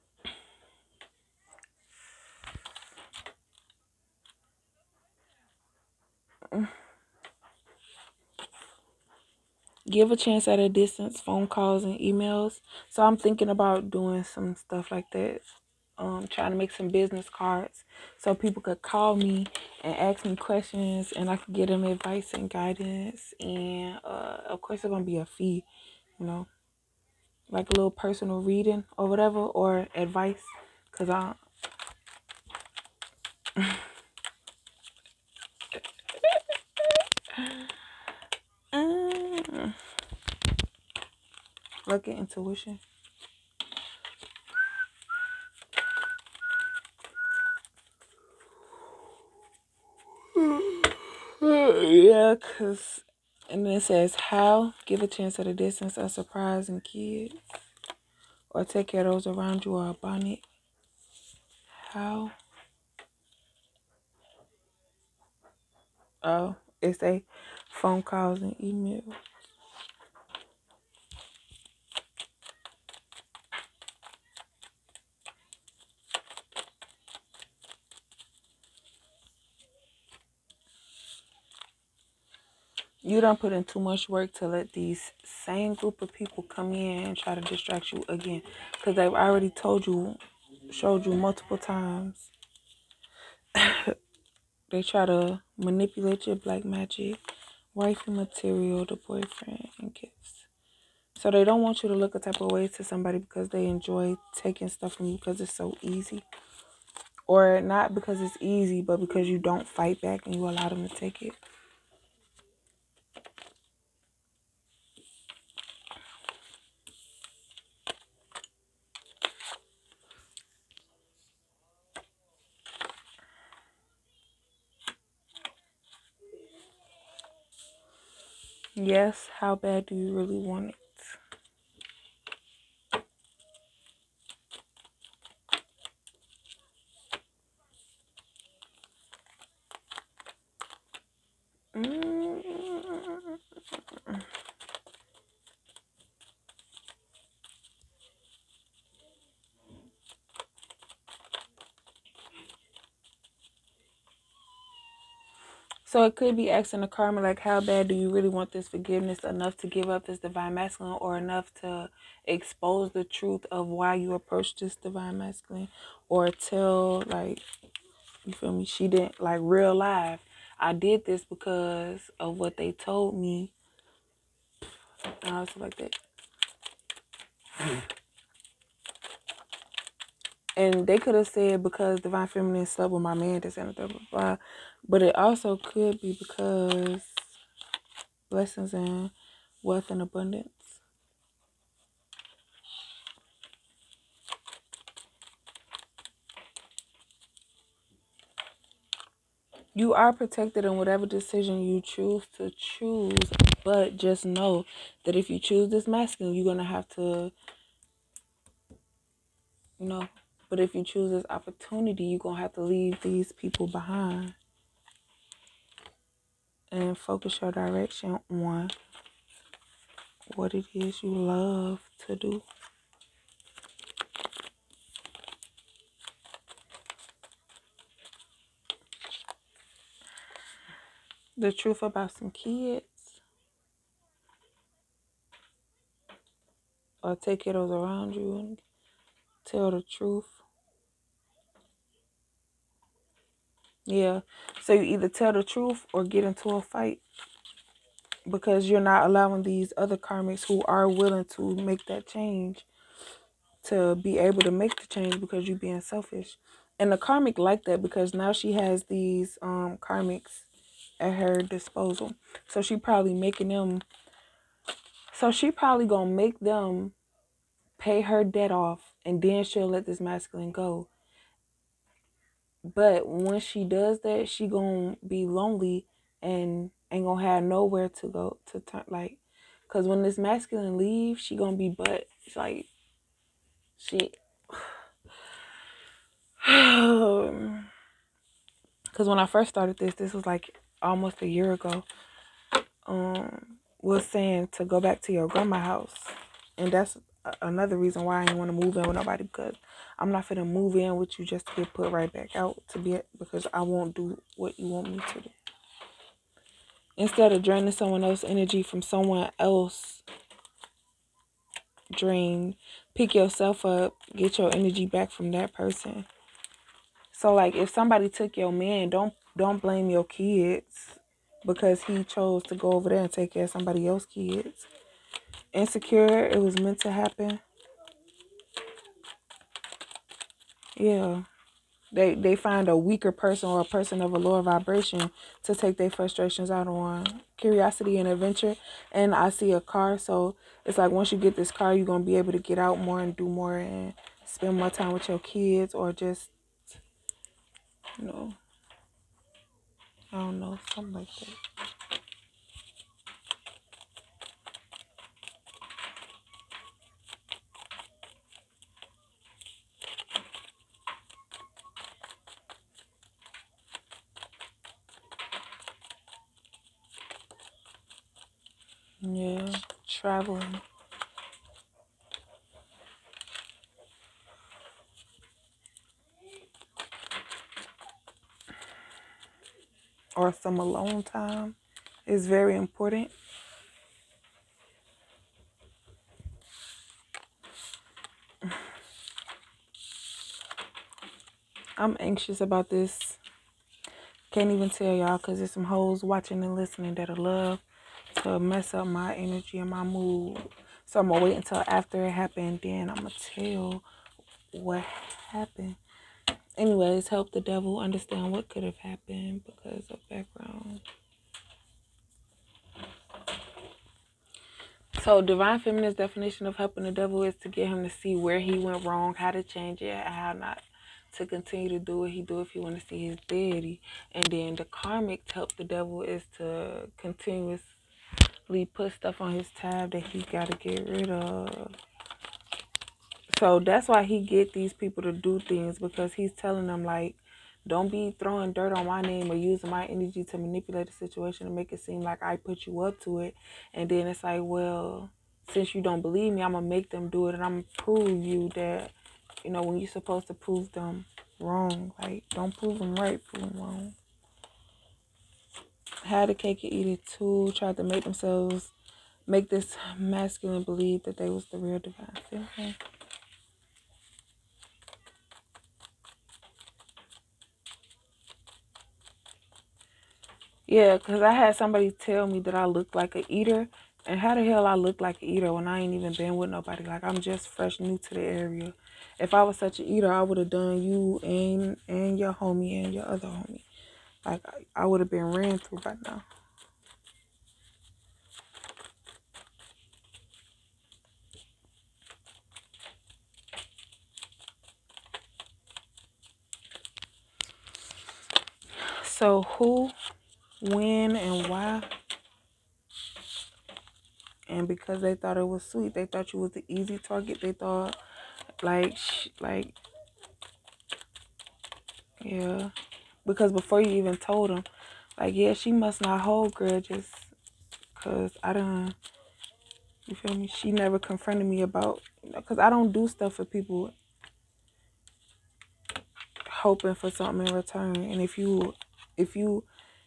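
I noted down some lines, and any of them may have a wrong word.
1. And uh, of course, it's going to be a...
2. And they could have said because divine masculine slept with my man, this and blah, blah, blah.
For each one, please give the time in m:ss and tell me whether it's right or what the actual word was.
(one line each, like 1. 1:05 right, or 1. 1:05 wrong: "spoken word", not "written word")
1. 0:23 right
2. 3:00 wrong: "feminine", not "masculine".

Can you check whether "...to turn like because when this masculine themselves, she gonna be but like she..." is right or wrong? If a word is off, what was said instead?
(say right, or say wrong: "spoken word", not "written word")
wrong: "leaves", not "themselves".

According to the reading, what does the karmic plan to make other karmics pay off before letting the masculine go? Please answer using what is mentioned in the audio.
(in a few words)
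her debt.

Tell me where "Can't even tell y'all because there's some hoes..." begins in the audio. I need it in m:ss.
6:34.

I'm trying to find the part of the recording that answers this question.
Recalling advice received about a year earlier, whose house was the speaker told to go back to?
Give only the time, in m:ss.
4:55.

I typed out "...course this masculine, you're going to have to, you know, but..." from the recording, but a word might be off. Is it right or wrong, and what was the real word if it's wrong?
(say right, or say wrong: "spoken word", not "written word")
wrong: "choose", not "course".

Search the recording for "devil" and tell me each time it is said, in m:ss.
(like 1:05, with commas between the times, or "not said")
6:47, 6:56, 7:05.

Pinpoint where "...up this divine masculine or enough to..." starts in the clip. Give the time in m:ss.
2:39.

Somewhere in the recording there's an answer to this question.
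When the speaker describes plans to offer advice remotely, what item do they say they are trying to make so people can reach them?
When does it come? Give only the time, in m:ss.
0:16.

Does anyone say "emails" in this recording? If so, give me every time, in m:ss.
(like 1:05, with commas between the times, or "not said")
0:11, 1:08.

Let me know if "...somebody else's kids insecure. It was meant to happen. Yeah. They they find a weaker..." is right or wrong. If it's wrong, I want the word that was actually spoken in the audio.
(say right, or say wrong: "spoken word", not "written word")
right.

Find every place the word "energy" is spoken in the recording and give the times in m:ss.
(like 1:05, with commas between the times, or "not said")
5:08, 5:14, 6:39, 7:19.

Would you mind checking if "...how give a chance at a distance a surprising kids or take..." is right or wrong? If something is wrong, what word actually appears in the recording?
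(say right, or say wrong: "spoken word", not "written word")
right.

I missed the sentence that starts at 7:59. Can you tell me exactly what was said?
If I was such an eater, I would have done you and, and your homie and your other homie.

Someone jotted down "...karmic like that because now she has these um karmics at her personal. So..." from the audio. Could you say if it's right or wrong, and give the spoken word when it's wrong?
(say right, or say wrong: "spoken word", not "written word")
wrong: "disposal", not "personal".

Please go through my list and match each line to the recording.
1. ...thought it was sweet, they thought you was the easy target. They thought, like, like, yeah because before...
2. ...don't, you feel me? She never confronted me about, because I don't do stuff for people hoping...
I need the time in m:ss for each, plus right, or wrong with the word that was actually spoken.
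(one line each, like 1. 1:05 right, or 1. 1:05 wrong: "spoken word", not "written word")
1. 8:25 right
2. 8:38 right.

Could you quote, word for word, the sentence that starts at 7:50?
Yeah, because I had somebody tell me that I looked like an eater.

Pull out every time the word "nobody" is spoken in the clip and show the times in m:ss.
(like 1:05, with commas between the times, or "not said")
4:58, 7:56.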